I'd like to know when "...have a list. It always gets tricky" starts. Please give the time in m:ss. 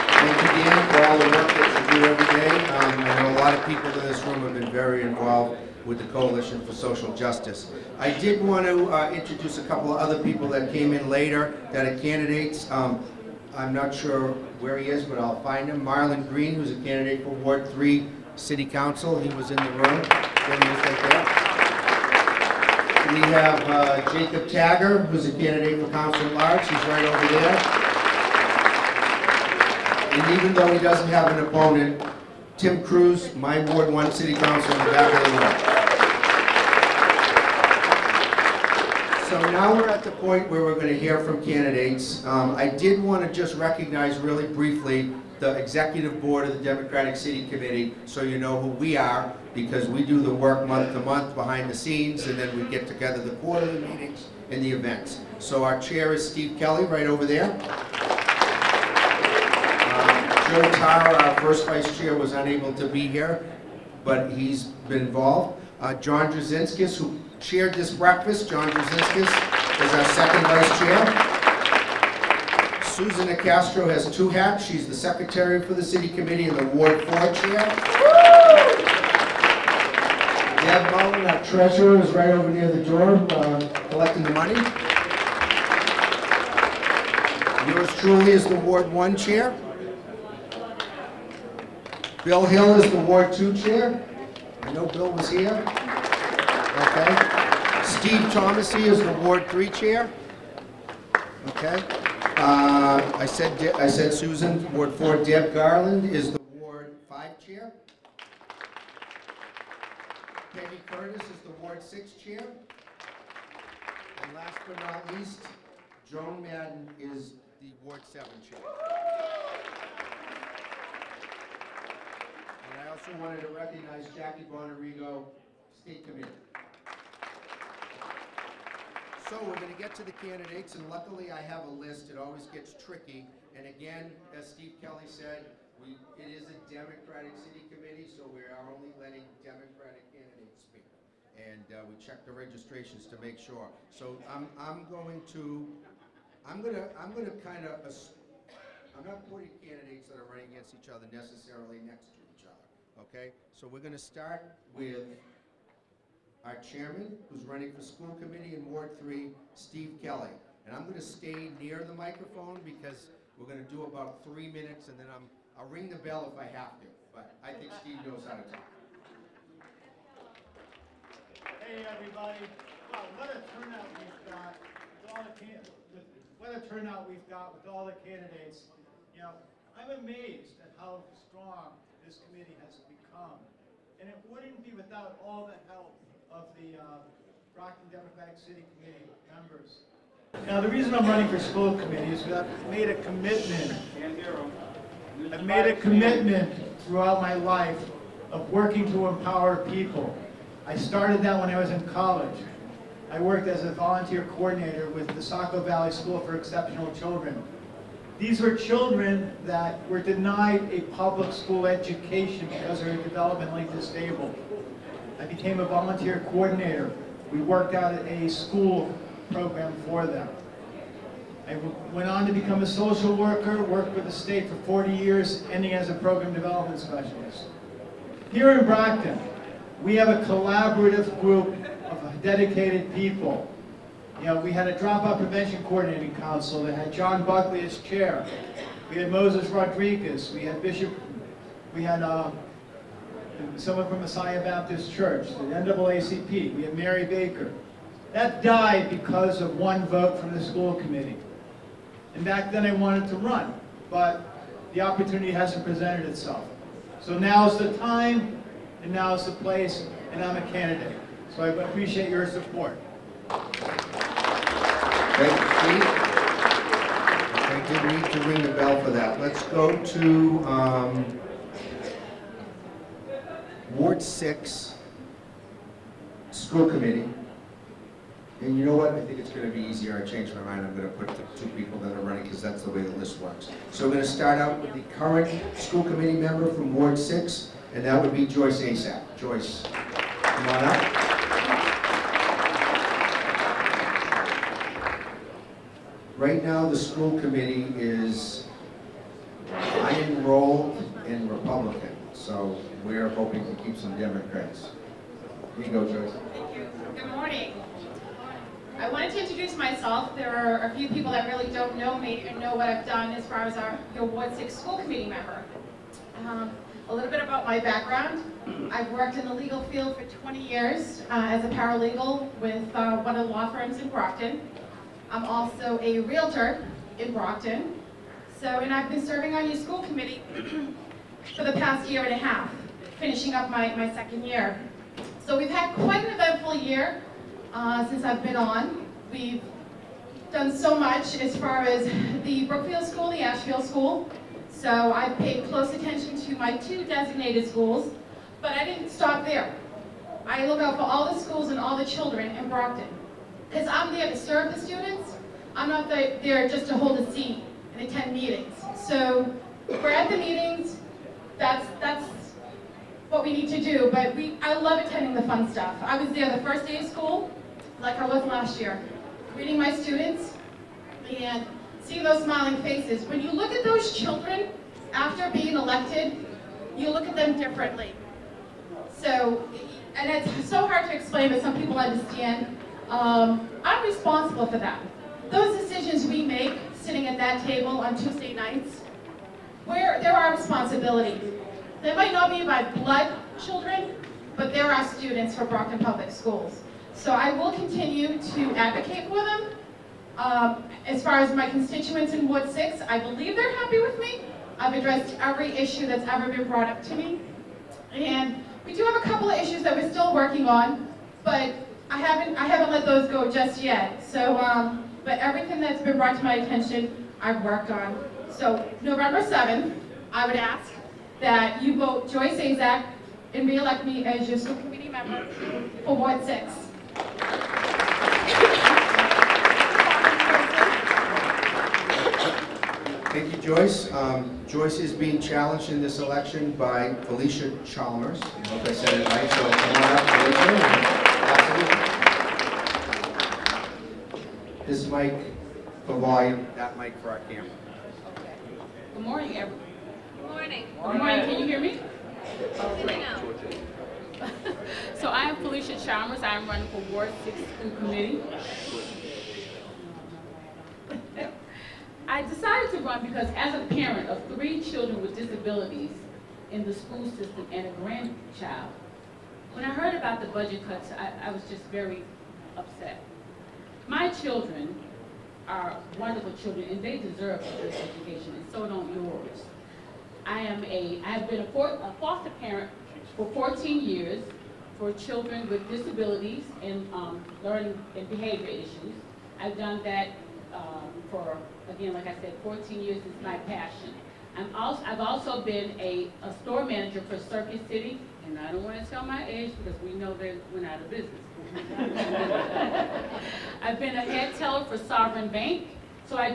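2:11.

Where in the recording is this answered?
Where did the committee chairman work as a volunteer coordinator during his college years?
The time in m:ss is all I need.
3:25.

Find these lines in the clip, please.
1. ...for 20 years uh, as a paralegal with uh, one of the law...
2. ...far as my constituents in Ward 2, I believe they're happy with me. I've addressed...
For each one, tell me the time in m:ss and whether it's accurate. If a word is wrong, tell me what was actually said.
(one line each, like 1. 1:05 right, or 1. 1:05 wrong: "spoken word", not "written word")
1. 5:19 right
2. 6:41 wrong: "6", not "2".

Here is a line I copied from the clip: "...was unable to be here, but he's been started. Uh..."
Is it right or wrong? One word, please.
wrong.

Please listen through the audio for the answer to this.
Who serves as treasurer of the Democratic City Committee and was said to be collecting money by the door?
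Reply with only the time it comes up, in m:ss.
1:20.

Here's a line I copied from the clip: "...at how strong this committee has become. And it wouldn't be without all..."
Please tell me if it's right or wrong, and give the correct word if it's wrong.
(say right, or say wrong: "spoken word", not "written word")
right.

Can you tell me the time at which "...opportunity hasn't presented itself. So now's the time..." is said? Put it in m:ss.
4:14.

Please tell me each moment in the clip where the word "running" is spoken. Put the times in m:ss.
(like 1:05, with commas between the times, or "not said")
2:30, 2:37, 3:11, 4:42, 7:36.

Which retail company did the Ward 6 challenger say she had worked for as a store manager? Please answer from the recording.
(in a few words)
Circuit City.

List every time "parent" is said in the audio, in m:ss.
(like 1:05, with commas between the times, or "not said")
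7:43, 8:02.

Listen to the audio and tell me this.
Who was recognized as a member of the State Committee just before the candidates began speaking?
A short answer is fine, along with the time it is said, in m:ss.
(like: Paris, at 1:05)
Jackie Bonarigo, at 2:04.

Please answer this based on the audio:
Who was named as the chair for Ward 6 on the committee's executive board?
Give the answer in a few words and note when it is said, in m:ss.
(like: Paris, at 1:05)
Peggy Curtis, at 1:50.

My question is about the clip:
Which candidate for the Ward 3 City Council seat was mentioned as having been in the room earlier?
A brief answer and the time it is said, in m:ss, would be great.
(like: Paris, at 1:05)
Marlon Green, at 0:15.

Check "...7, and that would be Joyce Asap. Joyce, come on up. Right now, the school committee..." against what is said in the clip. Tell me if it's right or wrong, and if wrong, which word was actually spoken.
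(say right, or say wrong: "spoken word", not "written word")
wrong: "6", not "7".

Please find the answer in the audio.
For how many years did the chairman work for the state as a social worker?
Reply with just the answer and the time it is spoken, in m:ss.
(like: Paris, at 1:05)
40, at 3:44.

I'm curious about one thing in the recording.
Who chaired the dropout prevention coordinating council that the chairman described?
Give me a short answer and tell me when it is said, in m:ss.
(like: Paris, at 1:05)
John Buckley, at 3:56.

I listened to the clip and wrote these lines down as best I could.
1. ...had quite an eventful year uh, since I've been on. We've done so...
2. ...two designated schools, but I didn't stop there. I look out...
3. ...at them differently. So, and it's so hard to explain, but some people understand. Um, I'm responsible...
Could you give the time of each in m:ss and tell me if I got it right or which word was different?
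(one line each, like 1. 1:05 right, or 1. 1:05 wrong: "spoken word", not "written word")
1. 5:35 right
2. 5:46 right
3. 6:17 right.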